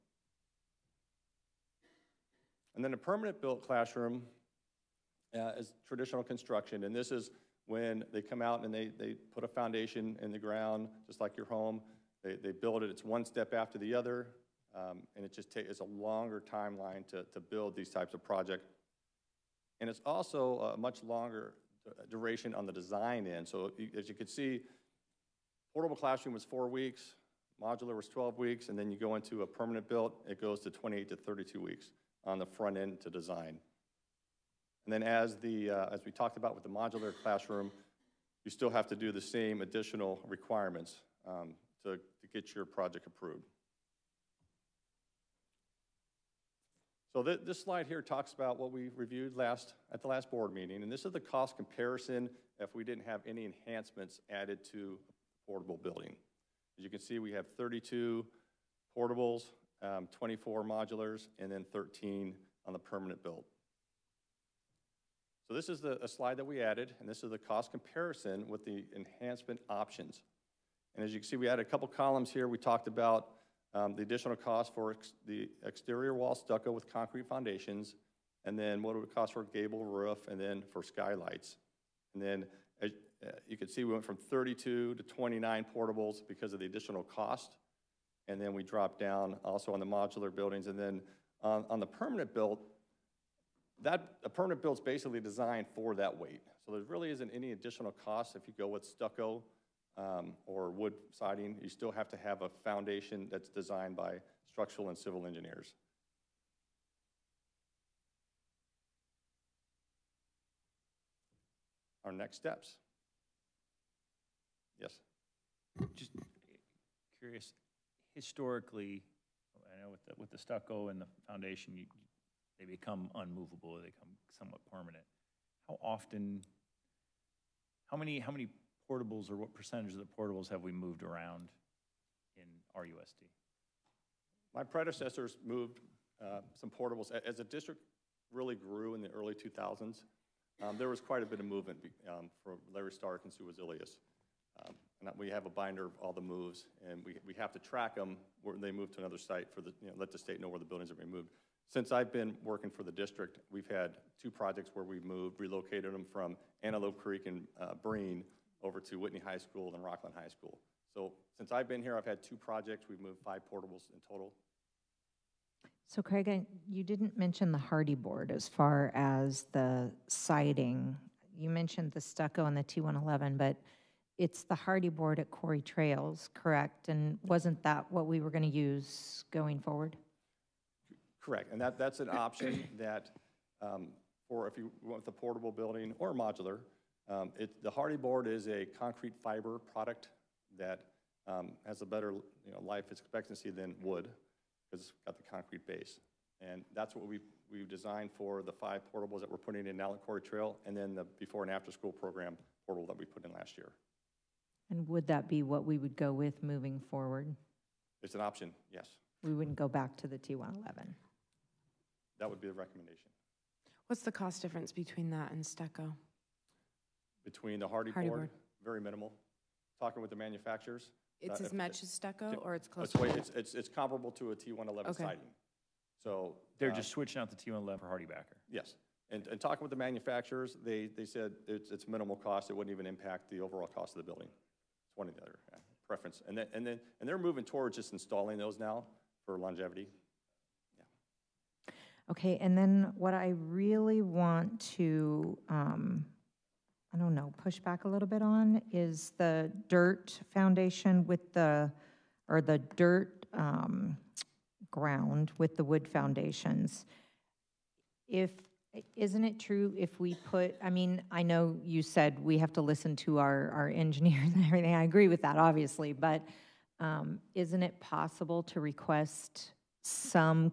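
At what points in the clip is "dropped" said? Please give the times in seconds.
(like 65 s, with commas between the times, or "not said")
88 s.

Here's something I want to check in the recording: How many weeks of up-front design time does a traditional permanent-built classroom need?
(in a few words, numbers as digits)
28 to 32 weeks.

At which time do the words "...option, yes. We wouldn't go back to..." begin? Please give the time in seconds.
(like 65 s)
208 s.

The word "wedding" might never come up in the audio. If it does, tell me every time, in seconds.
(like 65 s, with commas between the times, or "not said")
not said.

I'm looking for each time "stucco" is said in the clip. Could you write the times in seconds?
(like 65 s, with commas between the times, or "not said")
76 s, 98 s, 120 s, 171 s, 215 s, 221 s.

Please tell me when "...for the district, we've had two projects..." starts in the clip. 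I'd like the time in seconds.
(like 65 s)
152 s.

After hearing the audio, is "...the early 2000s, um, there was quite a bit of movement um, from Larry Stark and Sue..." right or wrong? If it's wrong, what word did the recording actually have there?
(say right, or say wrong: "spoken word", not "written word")
right.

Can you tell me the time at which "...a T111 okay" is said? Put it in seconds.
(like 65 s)
224 s.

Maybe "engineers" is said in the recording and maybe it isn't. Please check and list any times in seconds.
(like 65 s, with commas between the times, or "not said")
105 s, 263 s.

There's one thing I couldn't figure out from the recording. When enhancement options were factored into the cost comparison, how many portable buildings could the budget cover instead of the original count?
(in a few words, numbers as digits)
29.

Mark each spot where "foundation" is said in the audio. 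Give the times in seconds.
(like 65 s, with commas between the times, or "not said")
9 s, 77 s, 102 s, 121 s, 250 s, 255 s.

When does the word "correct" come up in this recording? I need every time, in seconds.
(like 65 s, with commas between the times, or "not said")
176 s, 181 s.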